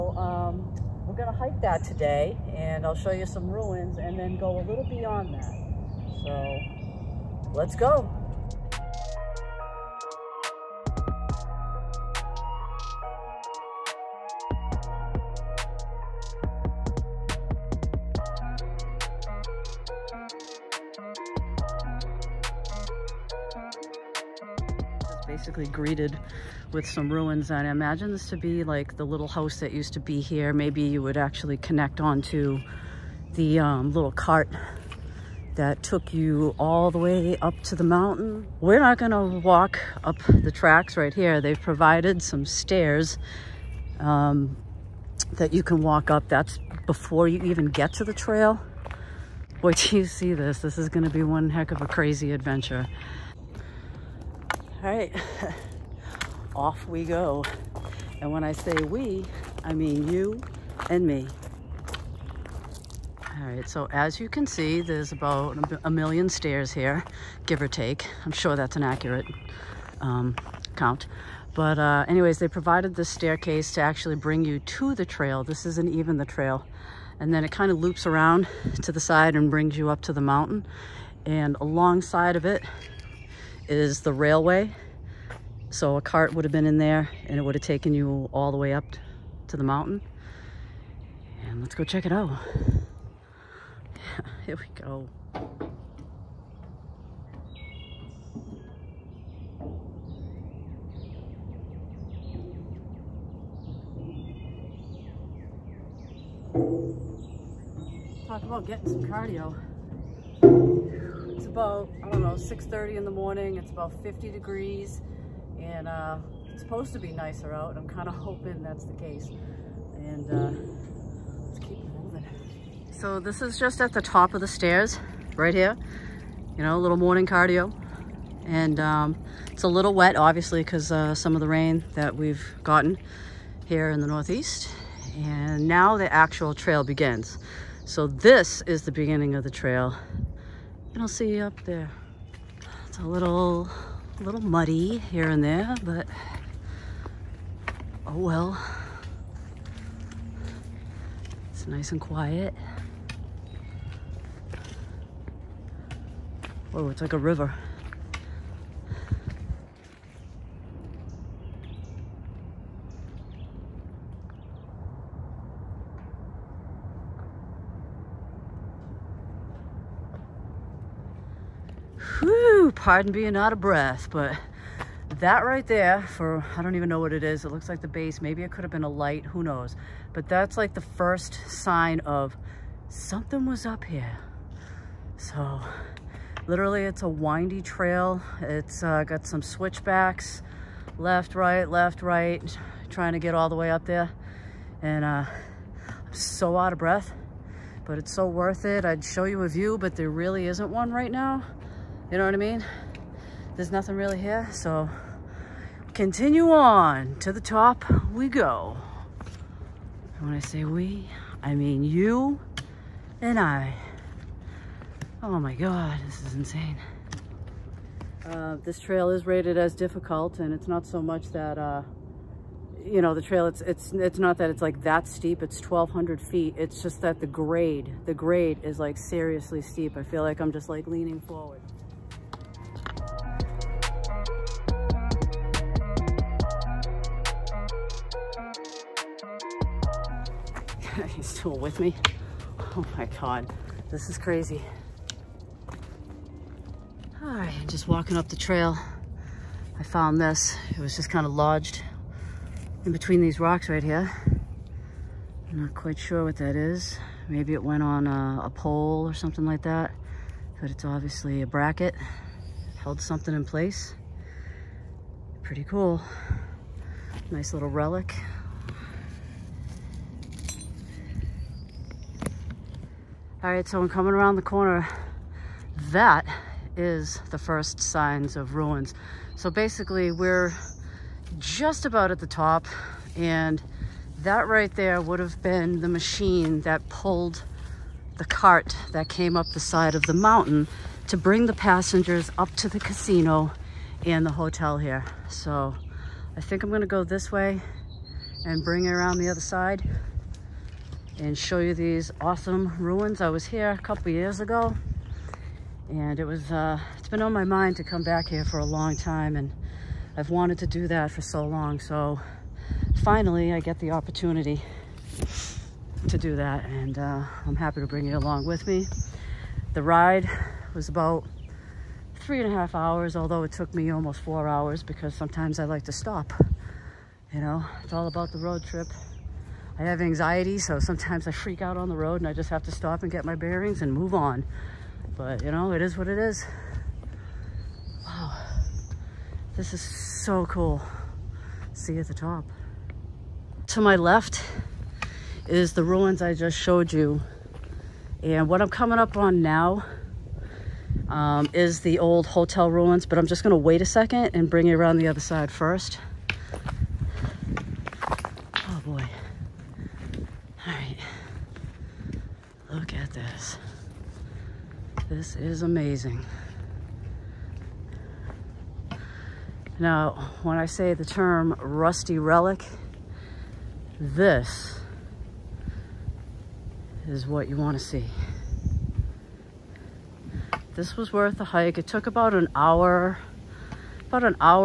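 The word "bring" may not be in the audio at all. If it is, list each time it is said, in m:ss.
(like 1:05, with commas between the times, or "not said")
1:14, 1:19, 4:51, 4:58, 5:17, 5:54.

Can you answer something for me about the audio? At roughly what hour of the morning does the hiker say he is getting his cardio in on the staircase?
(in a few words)
6:30.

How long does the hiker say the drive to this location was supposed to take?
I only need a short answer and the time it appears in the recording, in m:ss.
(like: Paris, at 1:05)
3.5 hours, at 5:22.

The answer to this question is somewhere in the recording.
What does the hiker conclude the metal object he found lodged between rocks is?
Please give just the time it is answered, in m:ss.
4:21.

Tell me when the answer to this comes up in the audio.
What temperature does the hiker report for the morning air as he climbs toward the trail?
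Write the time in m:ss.
1:54.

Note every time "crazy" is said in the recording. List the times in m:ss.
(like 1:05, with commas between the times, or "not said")
0:51, 4:04.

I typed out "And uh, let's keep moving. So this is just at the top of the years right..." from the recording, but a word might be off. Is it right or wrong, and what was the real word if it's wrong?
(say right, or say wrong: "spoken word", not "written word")
wrong: "stairs", not "years".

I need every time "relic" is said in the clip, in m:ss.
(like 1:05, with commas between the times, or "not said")
4:27, 6:12.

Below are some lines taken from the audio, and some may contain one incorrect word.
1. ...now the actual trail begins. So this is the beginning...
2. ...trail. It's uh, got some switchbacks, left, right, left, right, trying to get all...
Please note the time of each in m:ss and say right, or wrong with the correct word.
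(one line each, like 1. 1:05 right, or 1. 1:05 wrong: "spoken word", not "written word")
1. 2:15 right
2. 3:07 right.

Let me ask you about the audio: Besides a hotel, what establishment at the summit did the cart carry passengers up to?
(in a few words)
Casino.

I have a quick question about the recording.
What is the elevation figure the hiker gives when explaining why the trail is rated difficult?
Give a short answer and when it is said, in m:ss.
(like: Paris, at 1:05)
1200 feet, at 3:45.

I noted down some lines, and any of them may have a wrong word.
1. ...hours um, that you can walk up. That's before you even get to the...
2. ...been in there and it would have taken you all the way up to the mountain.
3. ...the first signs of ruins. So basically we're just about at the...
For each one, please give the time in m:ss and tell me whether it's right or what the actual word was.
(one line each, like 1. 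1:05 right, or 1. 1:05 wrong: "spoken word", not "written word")
1. 0:42 wrong: "stairs", not "hours"
2. 1:26 right
3. 4:37 right.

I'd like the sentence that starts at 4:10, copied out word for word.
It was just kind of lodged in between these rocks right here.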